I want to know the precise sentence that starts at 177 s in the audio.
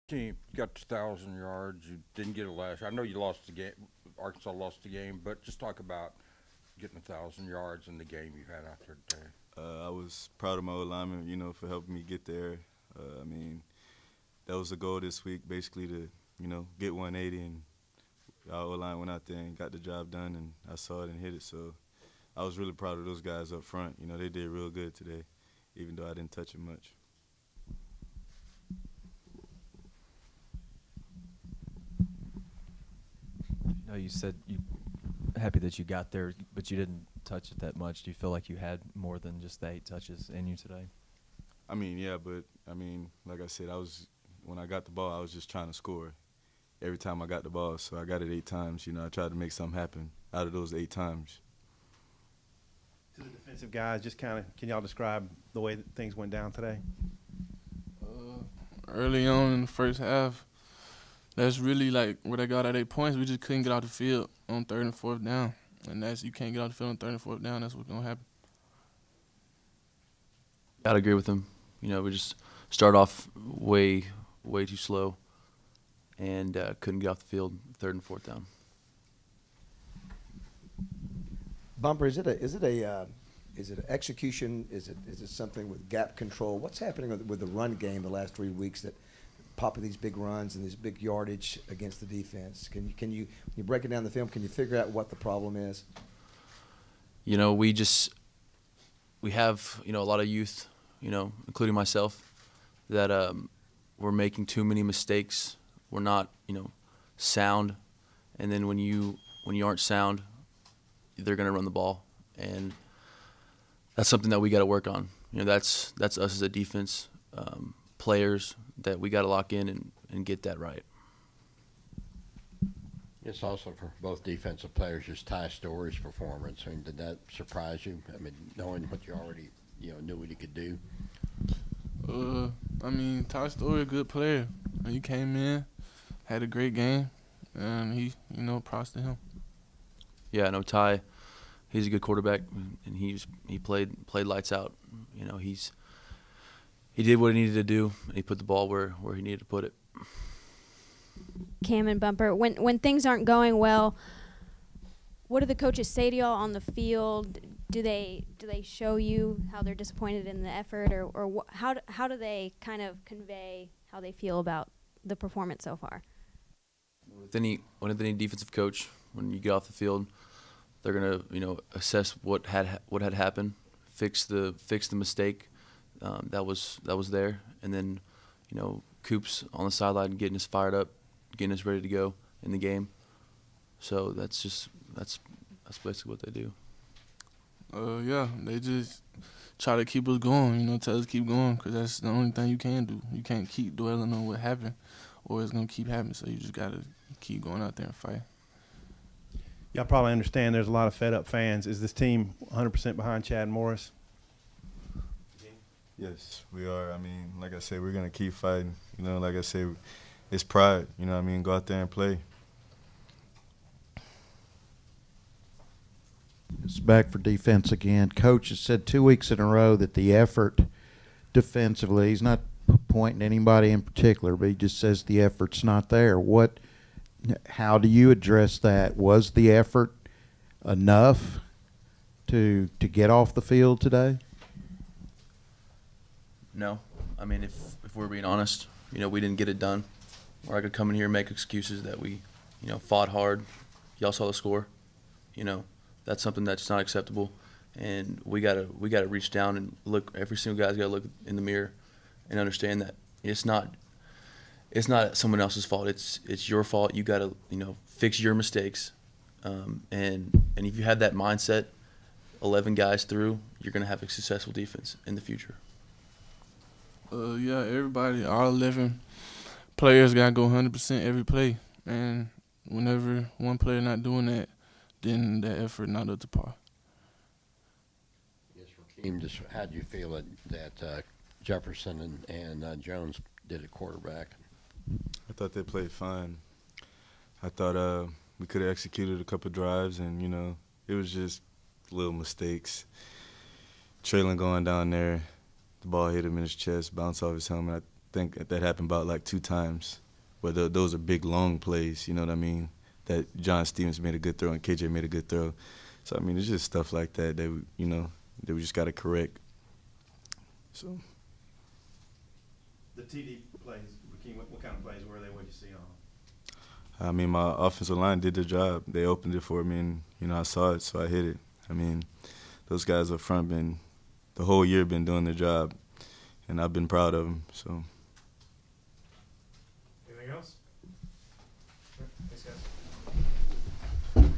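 And then, you know, Coops on the sideline getting us fired up, getting us ready to go in the game.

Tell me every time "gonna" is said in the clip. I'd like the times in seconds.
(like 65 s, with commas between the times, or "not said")
67 s, 111 s, 170 s, 195 s, 207 s, 263 s.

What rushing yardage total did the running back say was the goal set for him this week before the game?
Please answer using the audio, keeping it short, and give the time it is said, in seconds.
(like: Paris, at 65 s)
180, at 16 s.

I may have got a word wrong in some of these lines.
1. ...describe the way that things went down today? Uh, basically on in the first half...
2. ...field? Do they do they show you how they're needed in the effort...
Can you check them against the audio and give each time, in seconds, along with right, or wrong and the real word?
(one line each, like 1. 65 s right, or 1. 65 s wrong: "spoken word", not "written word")
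1. 54 s wrong: "early", not "basically"
2. 156 s wrong: "disappointed", not "needed".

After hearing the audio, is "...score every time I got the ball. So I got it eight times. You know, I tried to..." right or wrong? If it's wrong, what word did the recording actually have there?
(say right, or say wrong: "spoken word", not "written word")
right.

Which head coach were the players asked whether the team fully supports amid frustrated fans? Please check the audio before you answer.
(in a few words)
Chad Morris.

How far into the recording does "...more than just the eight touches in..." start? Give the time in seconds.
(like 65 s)
38 s.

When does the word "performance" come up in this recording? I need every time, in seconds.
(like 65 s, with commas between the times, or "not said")
125 s, 165 s.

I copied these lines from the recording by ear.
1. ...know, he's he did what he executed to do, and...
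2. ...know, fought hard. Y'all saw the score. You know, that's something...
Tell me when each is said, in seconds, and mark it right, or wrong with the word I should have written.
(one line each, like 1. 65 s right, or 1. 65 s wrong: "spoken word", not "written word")
1. 145 s wrong: "needed", not "executed"
2. 242 s right.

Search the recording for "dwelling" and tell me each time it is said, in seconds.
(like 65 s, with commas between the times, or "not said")
193 s.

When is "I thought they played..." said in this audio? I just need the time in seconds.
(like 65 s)
285 s.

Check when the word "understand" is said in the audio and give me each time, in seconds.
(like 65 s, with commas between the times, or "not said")
200 s, 252 s.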